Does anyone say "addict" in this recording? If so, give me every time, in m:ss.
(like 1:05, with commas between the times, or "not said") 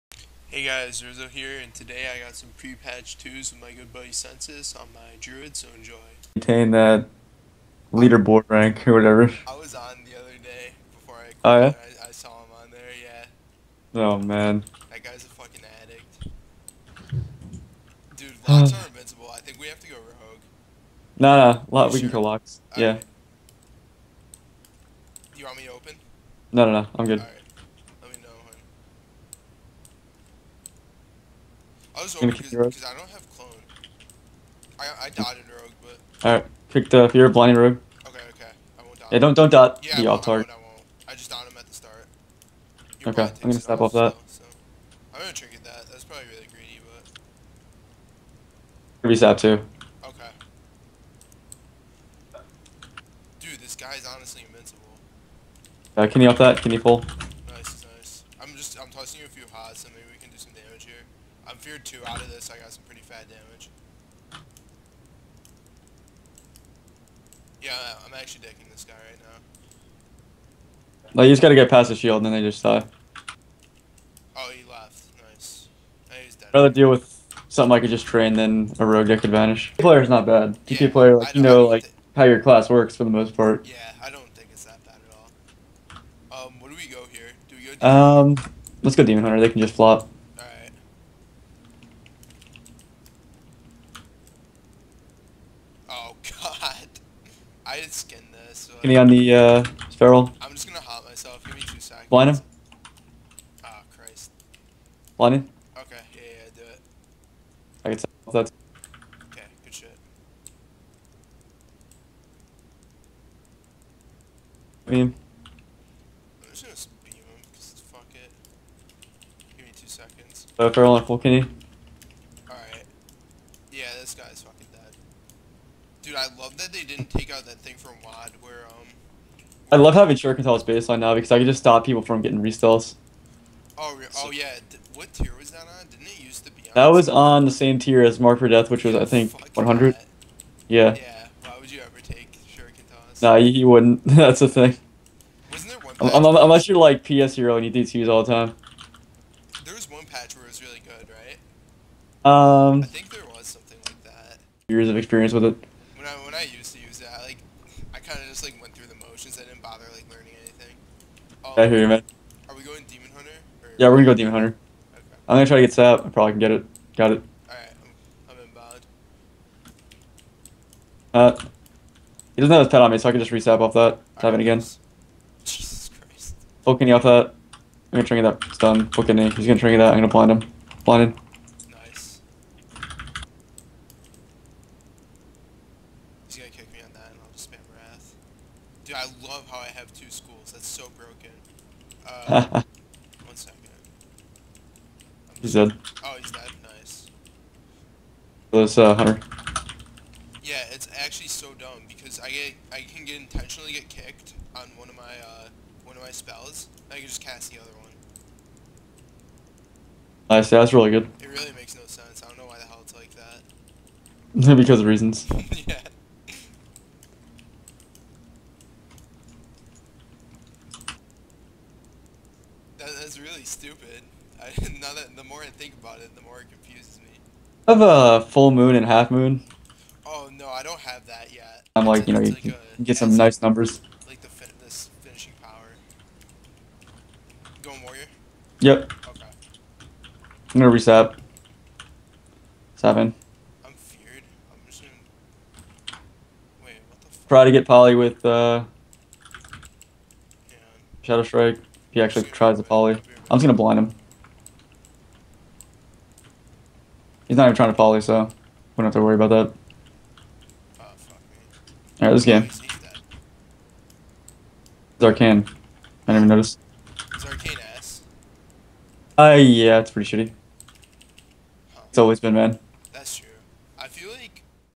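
0:15.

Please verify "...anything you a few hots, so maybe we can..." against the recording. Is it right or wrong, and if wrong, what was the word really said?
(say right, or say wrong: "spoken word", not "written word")
wrong: "tossing", not "anything".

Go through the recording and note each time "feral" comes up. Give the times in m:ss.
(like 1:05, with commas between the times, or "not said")
1:39, 2:00.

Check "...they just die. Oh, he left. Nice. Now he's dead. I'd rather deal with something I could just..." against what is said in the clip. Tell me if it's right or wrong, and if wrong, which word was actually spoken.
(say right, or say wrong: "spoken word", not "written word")
right.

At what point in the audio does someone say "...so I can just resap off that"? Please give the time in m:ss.
2:52.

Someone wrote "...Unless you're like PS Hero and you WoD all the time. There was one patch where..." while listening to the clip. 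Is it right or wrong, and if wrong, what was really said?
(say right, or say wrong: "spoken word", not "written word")
wrong: "DTs", not "WoD".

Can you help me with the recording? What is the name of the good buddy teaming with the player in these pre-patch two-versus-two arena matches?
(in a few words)
Sensus.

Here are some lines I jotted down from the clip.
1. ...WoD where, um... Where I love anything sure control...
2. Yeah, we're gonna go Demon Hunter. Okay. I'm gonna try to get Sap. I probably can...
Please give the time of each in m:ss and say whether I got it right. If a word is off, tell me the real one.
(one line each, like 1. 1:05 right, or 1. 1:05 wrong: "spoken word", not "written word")
1. 2:08 wrong: "having", not "anything"
2. 2:43 right.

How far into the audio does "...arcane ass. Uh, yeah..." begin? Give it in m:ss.
4:27.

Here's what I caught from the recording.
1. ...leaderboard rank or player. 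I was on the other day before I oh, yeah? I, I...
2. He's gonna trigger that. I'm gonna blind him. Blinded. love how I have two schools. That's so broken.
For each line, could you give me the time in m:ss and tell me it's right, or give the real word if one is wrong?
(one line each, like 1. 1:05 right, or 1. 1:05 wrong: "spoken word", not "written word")
1. 0:07 wrong: "whatever", not "player"
2. 2:59 right.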